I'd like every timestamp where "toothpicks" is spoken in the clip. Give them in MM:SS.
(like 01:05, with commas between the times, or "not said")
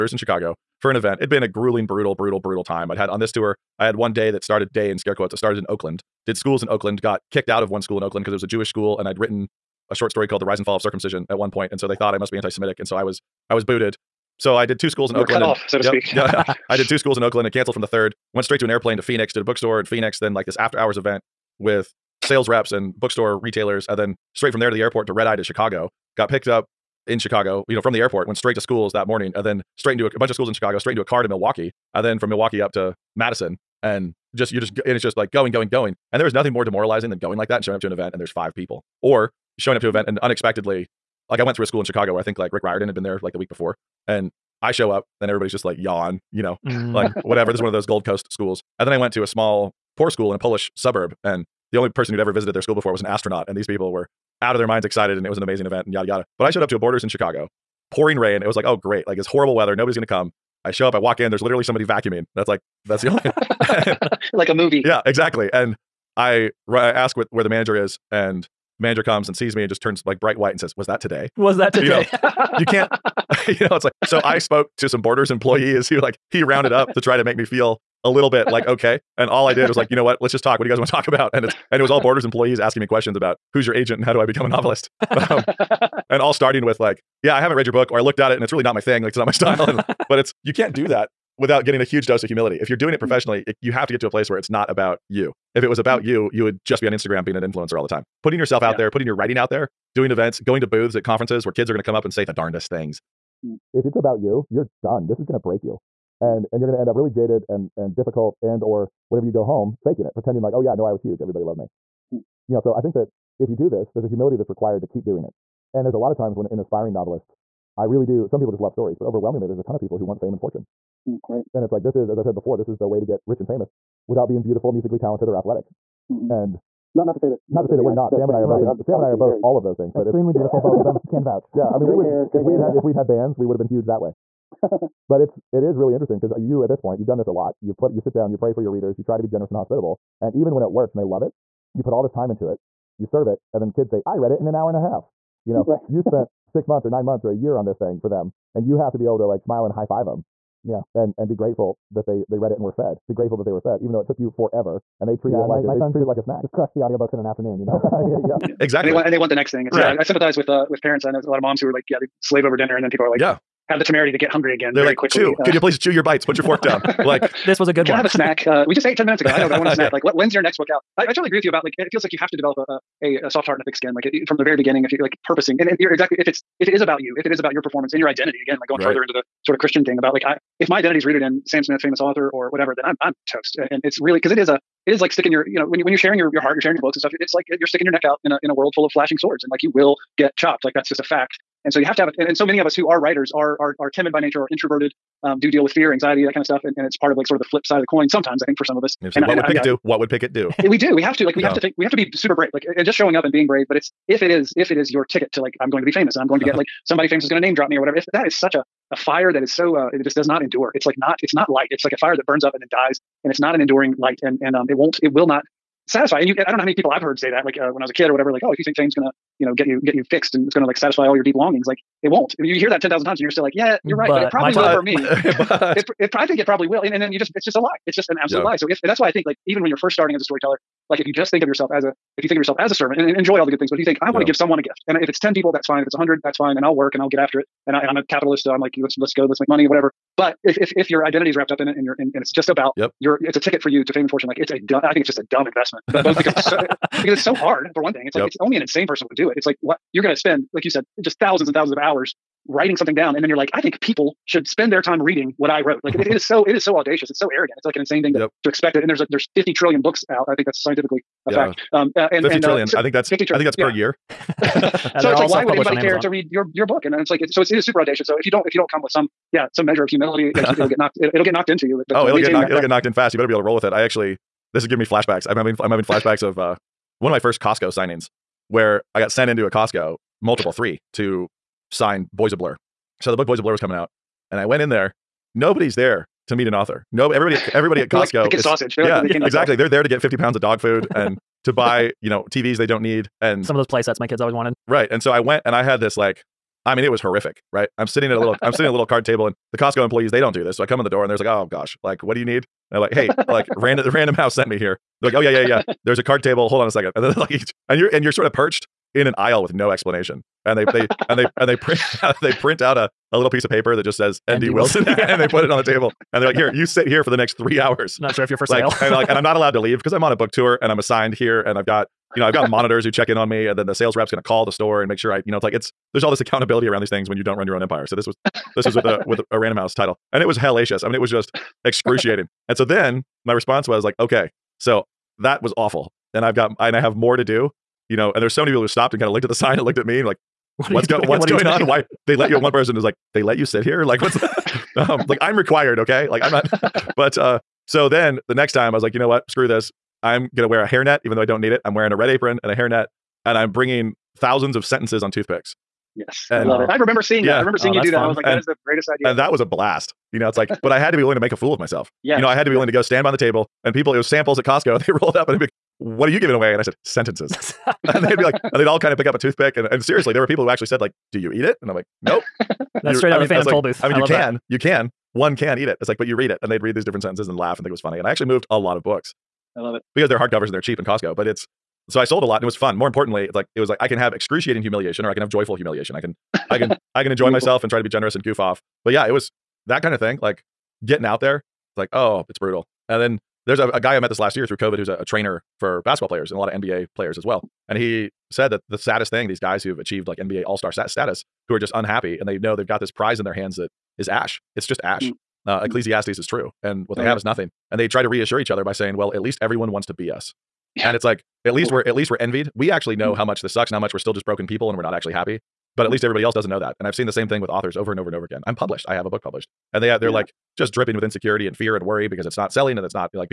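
05:55, 06:09.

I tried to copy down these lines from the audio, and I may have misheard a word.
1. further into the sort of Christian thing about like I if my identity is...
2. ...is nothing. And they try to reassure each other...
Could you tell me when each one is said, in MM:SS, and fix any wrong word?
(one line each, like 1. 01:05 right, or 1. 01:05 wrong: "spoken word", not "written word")
1. 02:58 right
2. 06:47 right.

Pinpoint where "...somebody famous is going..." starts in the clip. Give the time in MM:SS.
03:26.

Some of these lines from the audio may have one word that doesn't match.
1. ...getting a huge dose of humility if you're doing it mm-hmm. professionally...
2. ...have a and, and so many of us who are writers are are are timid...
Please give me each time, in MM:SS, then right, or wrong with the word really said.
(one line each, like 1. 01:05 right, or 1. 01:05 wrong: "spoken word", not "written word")
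1. 01:31 right
2. 03:11 right.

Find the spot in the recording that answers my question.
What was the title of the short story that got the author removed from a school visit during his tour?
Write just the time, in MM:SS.
00:10.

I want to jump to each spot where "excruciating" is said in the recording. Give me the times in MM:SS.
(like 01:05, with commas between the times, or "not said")
05:31, 06:24.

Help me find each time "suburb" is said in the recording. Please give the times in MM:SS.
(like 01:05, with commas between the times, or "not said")
00:50.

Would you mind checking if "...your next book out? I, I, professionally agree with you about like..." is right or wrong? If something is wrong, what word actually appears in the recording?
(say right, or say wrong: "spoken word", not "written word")
wrong: "totally", not "professionally".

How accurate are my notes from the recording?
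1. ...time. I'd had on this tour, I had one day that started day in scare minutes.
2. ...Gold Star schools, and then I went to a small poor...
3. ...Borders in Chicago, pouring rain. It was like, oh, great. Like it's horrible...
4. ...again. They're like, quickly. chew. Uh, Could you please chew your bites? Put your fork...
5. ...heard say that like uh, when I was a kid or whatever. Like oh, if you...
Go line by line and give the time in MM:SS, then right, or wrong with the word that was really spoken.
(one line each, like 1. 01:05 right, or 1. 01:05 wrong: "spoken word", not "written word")
1. 00:02 wrong: "quotes", not "minutes"
2. 00:47 wrong: "Coast", not "Star"
3. 00:56 right
4. 02:44 right
5. 03:37 right.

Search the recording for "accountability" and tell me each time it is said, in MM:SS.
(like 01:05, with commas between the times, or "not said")
05:26.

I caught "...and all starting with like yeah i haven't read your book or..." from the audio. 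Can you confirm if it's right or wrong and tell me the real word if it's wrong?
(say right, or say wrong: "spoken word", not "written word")
right.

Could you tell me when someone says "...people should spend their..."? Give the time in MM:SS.
04:13.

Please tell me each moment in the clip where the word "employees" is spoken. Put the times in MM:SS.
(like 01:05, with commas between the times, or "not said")
01:15, 01:22, 04:59.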